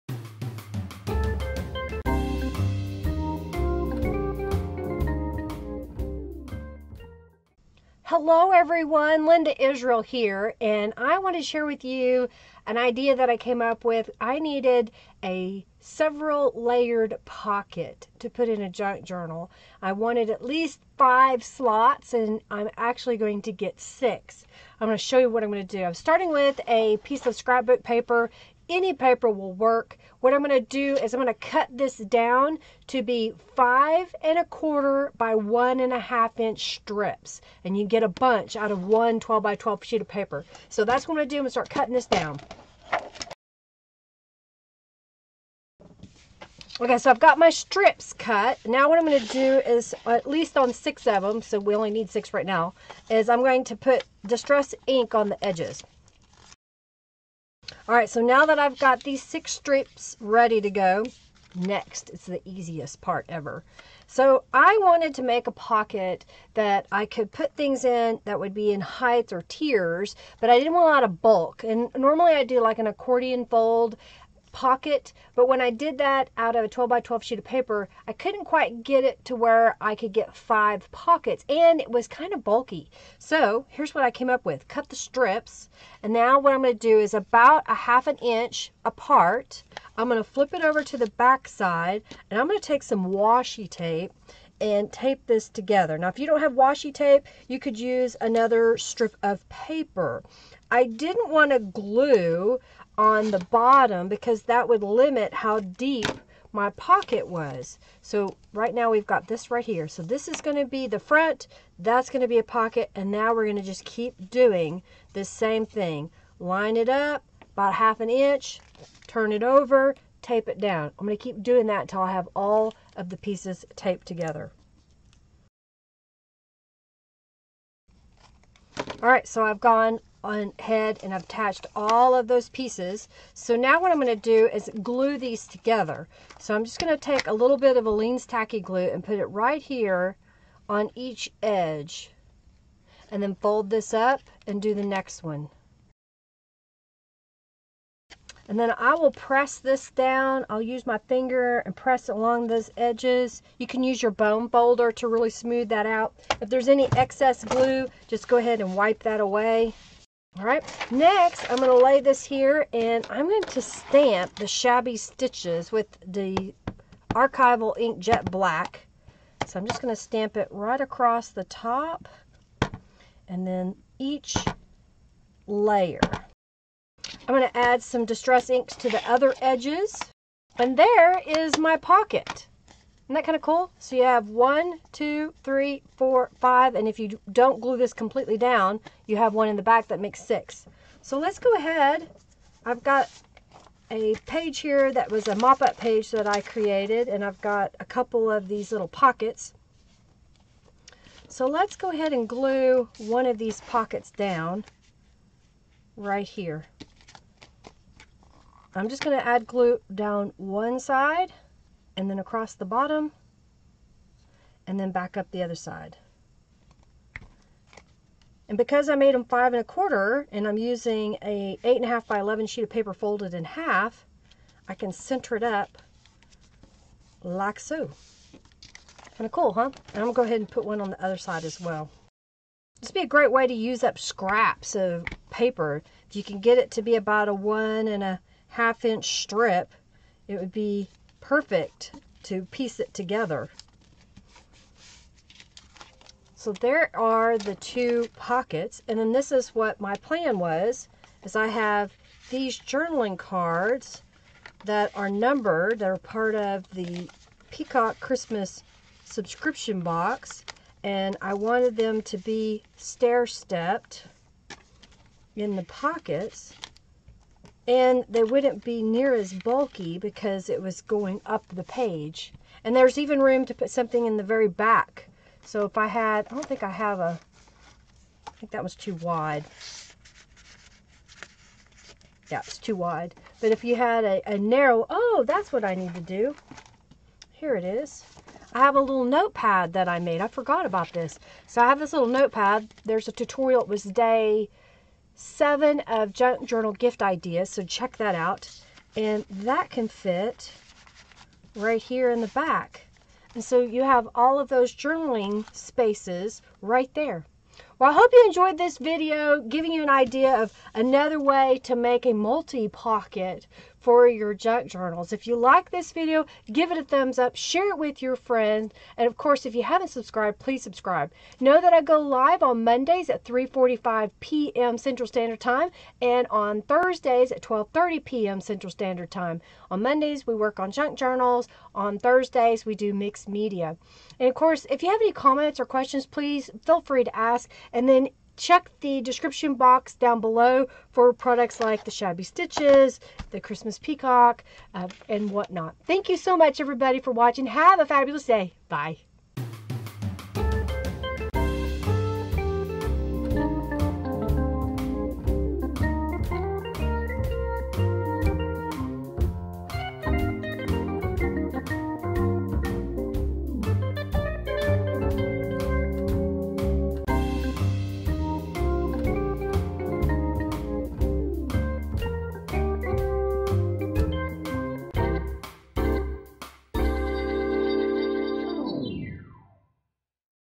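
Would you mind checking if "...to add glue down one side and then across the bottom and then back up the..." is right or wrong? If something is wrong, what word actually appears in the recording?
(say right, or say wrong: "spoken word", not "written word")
right.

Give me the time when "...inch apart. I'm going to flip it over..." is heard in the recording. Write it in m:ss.
1:28.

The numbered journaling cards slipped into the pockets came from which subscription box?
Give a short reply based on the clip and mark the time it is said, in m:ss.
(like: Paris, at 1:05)
Peacock Christmas, at 4:17.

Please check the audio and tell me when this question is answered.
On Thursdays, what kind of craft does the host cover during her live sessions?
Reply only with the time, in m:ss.
5:32.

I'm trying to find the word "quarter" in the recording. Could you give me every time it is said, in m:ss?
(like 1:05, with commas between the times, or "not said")
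0:34, 3:39.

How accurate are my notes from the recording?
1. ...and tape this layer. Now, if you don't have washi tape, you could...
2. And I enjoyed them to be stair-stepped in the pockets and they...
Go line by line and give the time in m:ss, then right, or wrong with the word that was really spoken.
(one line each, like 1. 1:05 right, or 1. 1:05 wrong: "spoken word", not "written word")
1. 1:34 wrong: "together", not "layer"
2. 4:20 wrong: "wanted", not "enjoyed".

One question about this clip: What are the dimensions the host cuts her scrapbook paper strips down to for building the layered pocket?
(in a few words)
5 1/4 by 1 1/2 inches.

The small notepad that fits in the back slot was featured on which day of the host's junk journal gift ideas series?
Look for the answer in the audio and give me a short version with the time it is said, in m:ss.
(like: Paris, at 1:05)
Day 7, at 4:53.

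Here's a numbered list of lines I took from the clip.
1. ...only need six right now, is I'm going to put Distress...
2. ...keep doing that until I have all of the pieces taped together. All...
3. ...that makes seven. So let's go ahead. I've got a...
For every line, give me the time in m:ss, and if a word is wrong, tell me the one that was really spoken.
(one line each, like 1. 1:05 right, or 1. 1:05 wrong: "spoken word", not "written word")
1. 0:51 right
2. 2:01 right
3. 3:09 wrong: "six", not "seven".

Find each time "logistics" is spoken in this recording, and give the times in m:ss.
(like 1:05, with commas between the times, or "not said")
not said.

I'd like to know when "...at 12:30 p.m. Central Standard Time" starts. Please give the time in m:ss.
5:27.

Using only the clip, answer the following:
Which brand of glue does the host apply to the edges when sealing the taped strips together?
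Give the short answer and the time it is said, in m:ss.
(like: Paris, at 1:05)
Aleene's Tacky Glue, at 2:17.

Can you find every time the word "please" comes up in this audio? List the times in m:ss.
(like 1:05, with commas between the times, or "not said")
5:20, 5:36.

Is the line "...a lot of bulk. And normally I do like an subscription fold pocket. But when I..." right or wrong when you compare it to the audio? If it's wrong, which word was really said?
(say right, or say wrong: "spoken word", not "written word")
wrong: "accordion", not "subscription".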